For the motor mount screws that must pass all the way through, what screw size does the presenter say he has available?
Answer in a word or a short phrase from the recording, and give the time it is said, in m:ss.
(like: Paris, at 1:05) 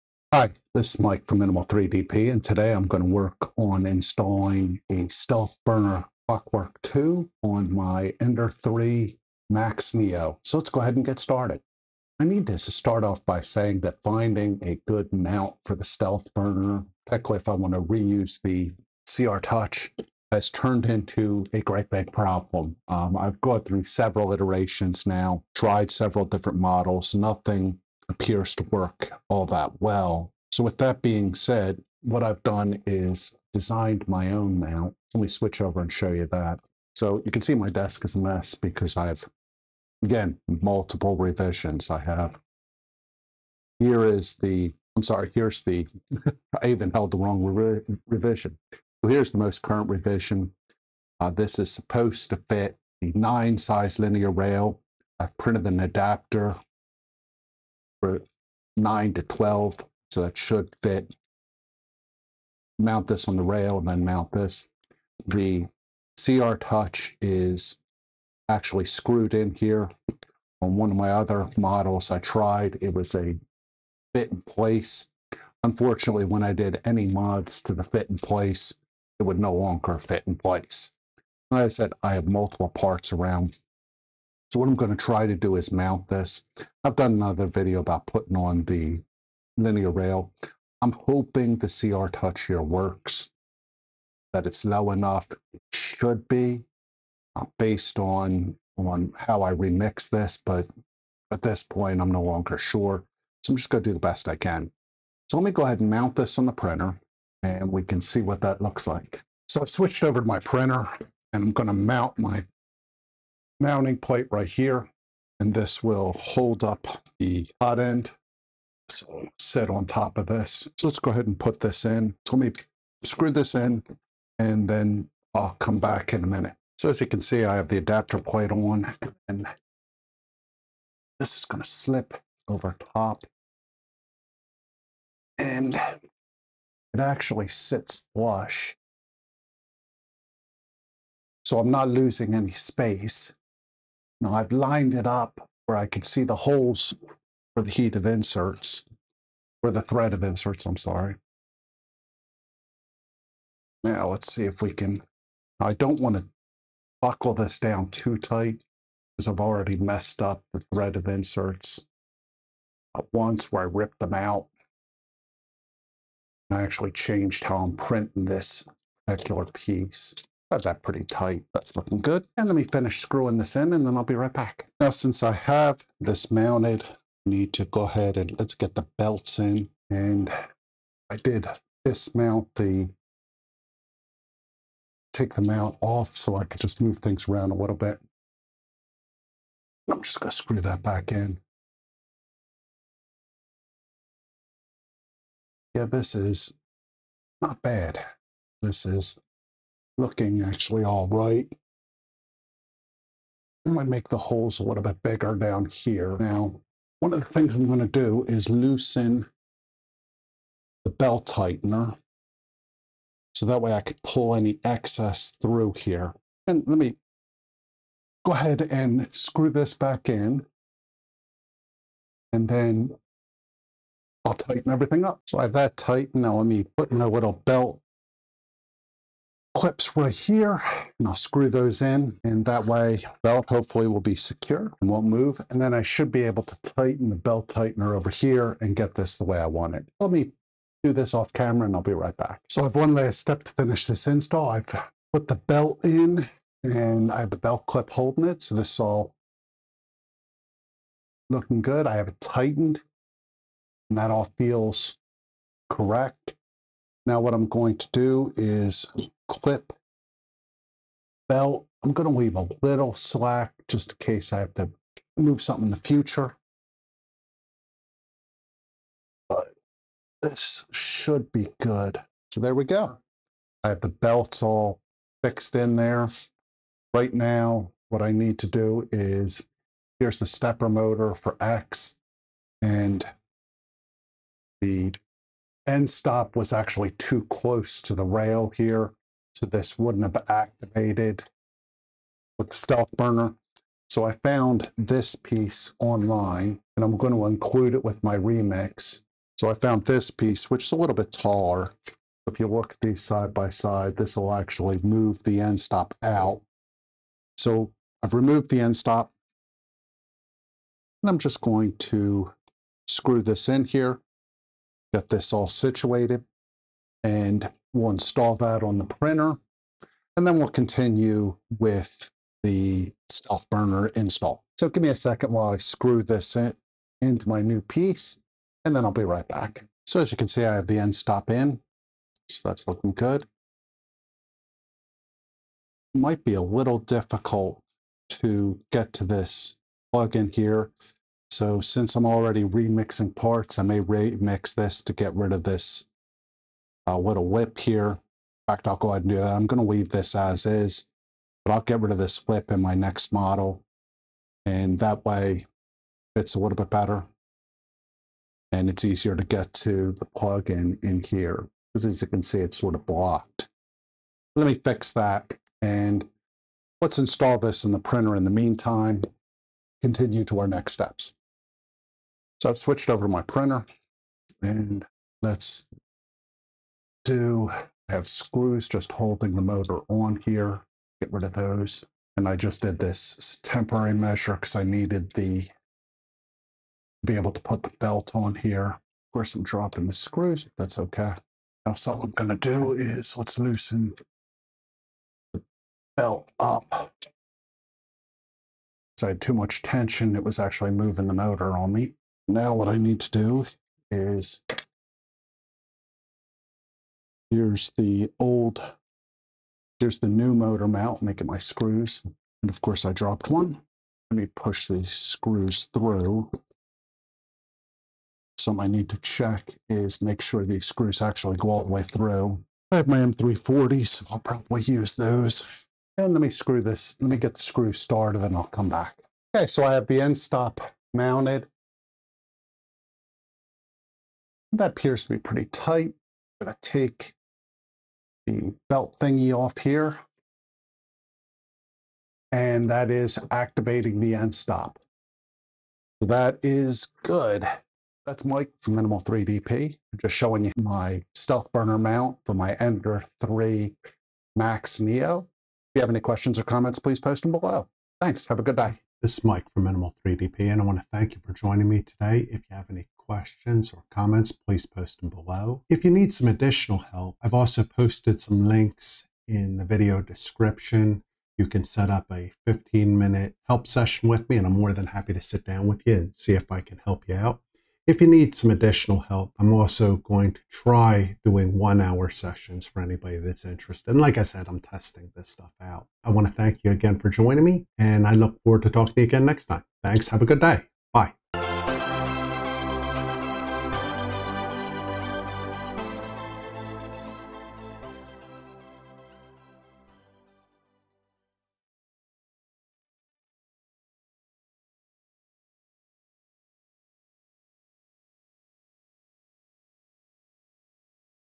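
M3x40, at 7:02.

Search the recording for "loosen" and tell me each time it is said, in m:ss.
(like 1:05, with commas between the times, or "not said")
3:28, 6:33.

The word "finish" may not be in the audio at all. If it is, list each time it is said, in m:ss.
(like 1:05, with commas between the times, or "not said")
2:52, 4:03.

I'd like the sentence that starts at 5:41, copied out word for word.
So since I'm already remixing parts, I may remix this to get rid of this I'll uh, whittle whip here.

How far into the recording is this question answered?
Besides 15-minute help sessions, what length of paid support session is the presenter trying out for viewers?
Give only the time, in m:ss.
8:01.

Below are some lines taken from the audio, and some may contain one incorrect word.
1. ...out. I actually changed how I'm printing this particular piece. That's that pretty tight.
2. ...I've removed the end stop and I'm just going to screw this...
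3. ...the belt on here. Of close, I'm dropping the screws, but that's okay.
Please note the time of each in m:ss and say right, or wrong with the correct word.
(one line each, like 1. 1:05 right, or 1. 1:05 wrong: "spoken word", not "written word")
1. 2:44 right
2. 5:08 right
3. 6:27 wrong: "course", not "close".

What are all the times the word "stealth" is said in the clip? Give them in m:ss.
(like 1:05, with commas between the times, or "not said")
0:05, 0:15, 4:52, 5:23, 7:31.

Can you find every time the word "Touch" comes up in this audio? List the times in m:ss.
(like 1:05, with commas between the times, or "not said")
0:19, 1:06, 1:32.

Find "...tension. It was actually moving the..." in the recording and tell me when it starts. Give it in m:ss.
6:39.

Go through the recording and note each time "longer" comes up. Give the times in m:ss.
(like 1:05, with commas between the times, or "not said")
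1:19, 1:42.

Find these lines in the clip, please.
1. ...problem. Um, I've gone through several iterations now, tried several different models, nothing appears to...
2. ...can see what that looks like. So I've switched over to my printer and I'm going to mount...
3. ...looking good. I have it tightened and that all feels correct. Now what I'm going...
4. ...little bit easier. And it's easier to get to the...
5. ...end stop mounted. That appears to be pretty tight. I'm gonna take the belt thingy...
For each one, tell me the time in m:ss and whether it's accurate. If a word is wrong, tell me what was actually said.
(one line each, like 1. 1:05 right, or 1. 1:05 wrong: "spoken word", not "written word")
1. 0:22 right
2. 1:47 right
3. 4:11 right
4. 5:56 wrong: "better", not "easier"
5. 7:10 right.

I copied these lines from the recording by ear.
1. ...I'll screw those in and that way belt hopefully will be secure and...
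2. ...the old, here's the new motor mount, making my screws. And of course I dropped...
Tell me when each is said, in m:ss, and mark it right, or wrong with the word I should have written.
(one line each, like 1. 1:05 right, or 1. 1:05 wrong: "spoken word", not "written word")
1. 3:51 right
2. 6:47 right.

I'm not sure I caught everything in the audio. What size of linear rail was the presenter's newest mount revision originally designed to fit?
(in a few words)
9.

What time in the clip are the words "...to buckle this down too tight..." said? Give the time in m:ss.
2:36.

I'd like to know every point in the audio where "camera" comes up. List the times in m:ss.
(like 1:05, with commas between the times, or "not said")
4:01.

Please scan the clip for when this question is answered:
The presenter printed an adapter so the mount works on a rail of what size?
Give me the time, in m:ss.
0:58.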